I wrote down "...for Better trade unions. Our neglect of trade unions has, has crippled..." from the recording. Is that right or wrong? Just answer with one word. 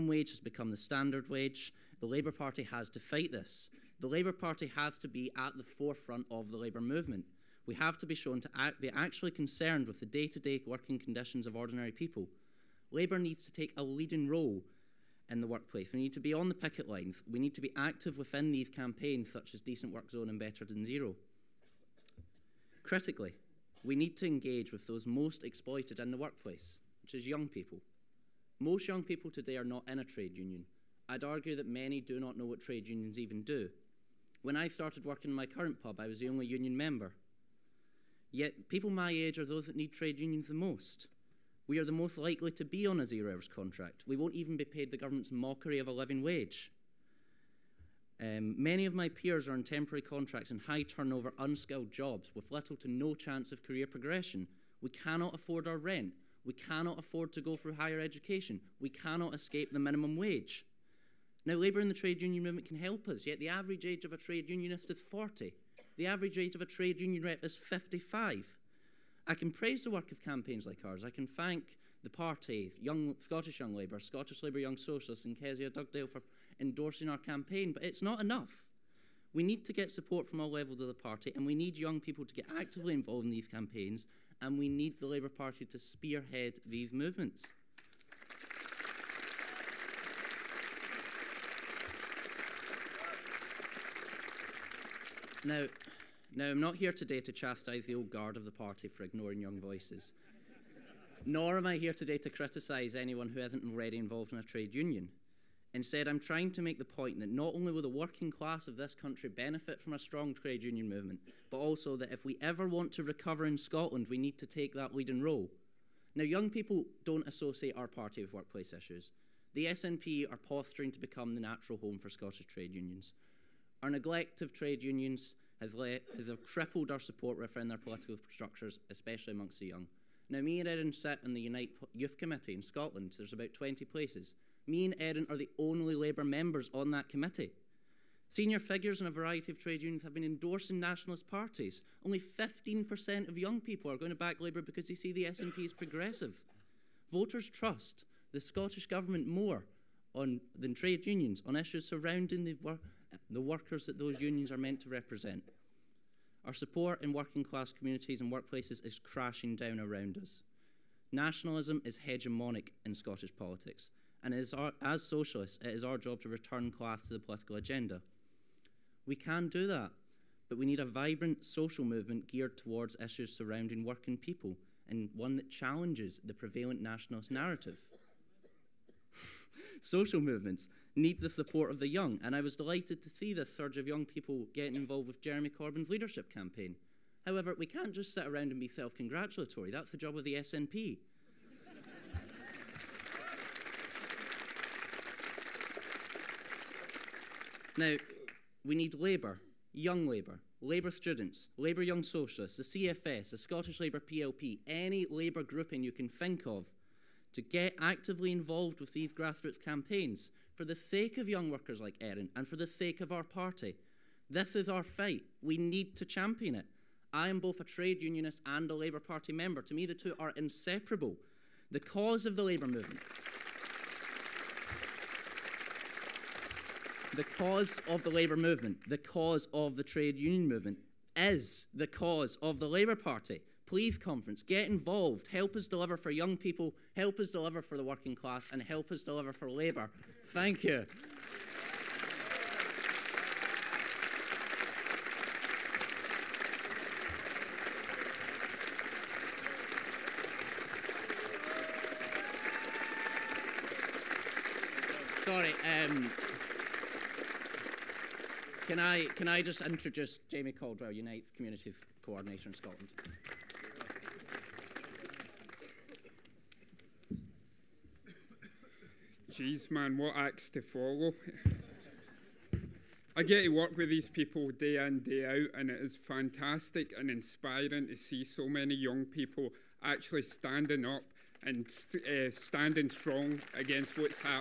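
wrong.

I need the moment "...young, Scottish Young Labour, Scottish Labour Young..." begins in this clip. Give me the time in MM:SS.
01:12.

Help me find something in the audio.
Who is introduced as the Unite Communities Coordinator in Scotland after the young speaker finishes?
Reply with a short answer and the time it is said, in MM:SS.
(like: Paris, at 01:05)
Jamie Caldwell, at 04:20.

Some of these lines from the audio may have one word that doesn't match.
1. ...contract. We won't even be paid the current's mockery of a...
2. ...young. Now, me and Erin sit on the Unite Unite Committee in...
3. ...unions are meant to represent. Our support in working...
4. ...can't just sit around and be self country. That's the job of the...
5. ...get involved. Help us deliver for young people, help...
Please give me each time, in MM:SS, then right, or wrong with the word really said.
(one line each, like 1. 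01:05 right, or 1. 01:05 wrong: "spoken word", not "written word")
1. 00:43 wrong: "government", not "current"
2. 02:09 wrong: "Youth", not "Unite"
3. 02:34 right
4. 03:07 wrong: "congratulatory", not "country"
5. 03:54 right.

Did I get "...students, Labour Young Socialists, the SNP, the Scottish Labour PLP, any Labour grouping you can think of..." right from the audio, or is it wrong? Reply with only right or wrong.
wrong.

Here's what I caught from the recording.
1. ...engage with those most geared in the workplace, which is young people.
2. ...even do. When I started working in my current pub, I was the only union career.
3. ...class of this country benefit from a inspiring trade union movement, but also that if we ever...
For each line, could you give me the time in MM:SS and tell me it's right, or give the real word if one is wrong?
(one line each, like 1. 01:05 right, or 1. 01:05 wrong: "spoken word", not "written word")
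1. 00:24 wrong: "exploited", not "geared"
2. 00:33 wrong: "member", not "career"
3. 01:48 wrong: "strong", not "inspiring".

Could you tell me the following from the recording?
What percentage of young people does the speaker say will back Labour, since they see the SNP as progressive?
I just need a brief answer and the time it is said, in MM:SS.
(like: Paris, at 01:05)
15%, at 02:22.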